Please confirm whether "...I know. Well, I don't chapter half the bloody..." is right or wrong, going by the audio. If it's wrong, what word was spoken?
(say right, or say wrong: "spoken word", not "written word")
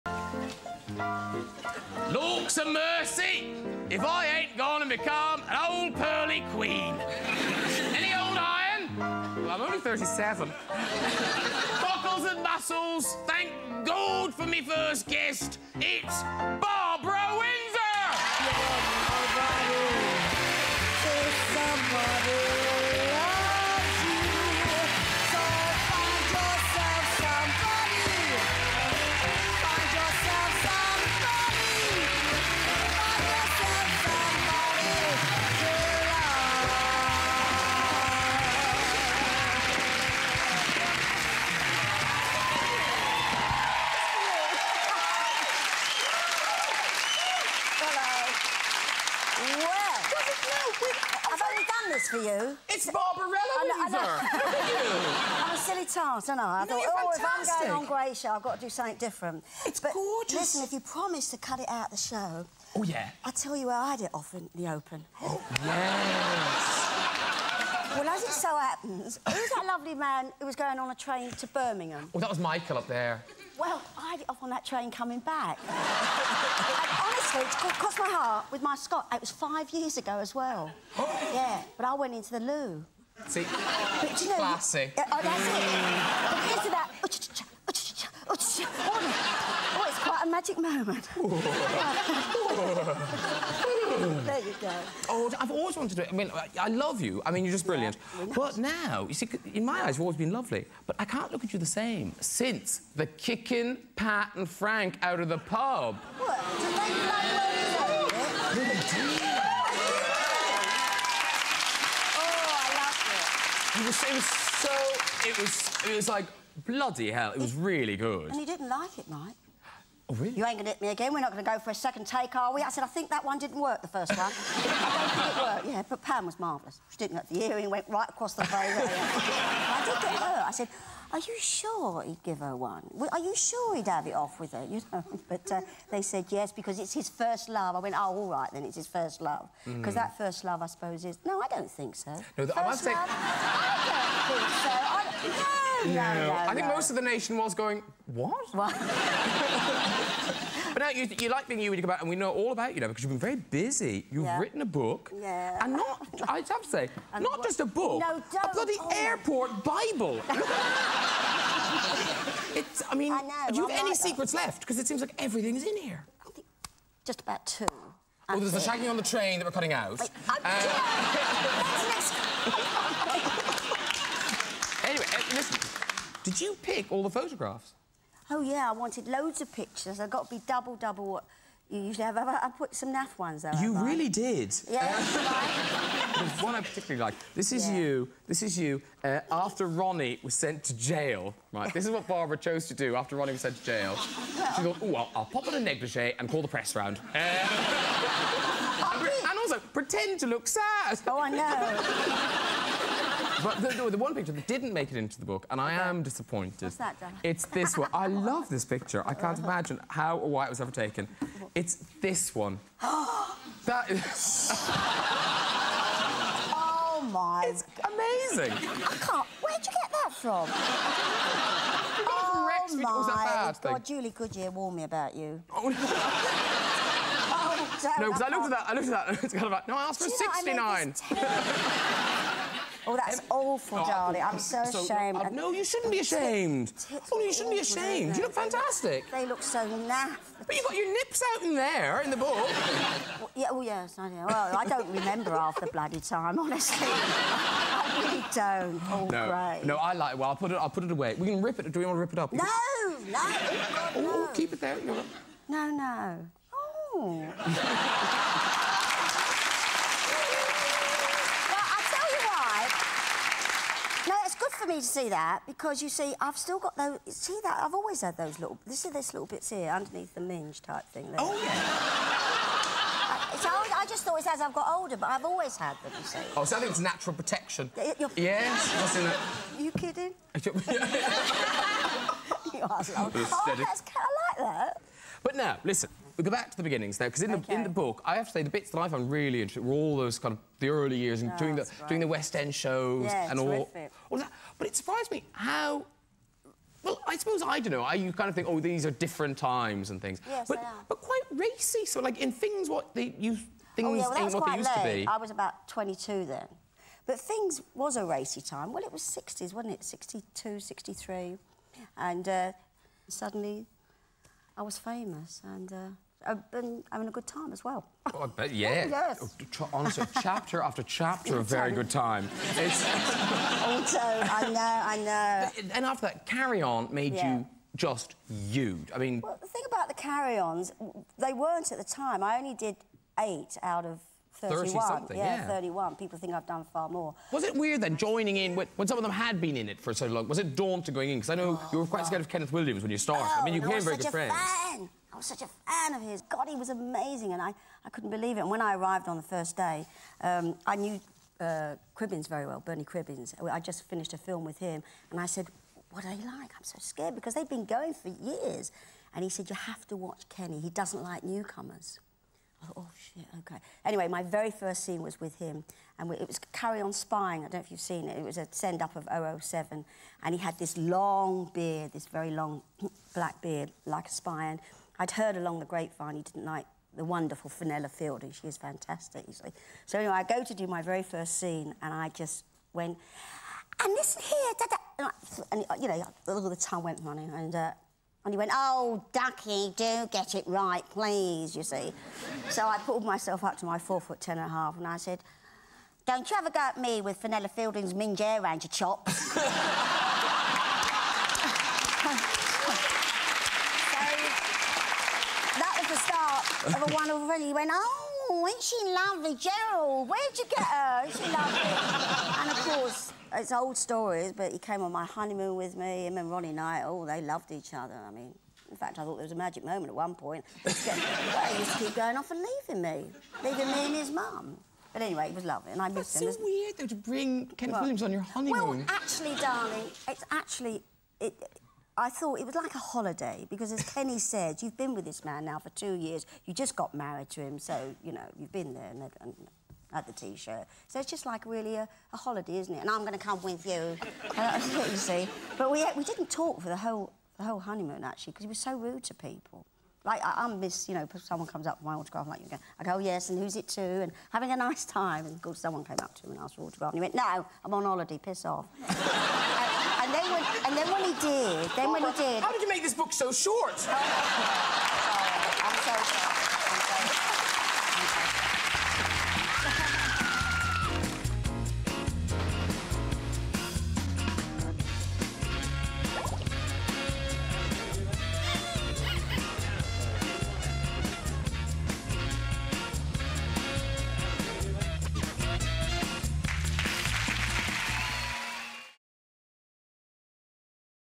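wrong: "remember", not "chapter".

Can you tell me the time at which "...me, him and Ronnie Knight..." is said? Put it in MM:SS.
06:55.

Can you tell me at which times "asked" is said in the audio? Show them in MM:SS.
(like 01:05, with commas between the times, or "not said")
03:49, 07:36.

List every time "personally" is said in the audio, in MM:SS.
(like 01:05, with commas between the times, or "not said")
not said.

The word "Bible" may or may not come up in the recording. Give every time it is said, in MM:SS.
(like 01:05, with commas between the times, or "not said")
02:39.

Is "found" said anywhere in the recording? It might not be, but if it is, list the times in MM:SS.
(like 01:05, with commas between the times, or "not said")
04:48.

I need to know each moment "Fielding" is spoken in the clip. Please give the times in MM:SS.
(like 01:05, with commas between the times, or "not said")
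06:17, 06:37.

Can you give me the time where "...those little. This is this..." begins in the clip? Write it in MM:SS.
04:28.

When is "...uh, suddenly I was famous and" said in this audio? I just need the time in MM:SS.
05:12.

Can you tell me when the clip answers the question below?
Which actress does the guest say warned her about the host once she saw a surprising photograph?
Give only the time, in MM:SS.
03:43.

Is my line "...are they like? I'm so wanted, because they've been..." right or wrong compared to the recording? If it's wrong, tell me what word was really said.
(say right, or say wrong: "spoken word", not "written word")
wrong: "scared", not "wanted".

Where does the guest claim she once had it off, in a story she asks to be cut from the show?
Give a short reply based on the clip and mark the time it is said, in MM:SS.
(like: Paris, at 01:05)
On a train, at 01:14.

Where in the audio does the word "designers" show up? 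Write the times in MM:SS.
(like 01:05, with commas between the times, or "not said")
not said.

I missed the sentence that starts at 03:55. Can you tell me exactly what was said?
No, no, you shouldn't be ashamed.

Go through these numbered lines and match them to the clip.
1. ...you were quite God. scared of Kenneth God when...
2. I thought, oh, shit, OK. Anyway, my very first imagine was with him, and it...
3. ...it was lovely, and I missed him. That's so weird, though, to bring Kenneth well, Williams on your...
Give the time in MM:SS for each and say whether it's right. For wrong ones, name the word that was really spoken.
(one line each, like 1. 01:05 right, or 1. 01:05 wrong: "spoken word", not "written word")
1. 05:41 wrong: "Williams", not "God"
2. 06:02 wrong: "scene", not "imagine"
3. 07:05 right.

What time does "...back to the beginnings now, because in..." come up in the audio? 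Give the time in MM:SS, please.
04:46.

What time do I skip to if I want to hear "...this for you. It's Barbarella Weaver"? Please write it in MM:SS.
00:51.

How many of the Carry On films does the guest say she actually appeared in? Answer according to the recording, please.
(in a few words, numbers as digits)
8.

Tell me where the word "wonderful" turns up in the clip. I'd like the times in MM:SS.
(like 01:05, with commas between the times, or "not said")
06:17, 06:46.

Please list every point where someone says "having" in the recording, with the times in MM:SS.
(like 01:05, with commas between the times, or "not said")
05:16, 07:34.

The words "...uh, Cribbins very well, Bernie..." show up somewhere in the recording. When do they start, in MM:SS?
05:51.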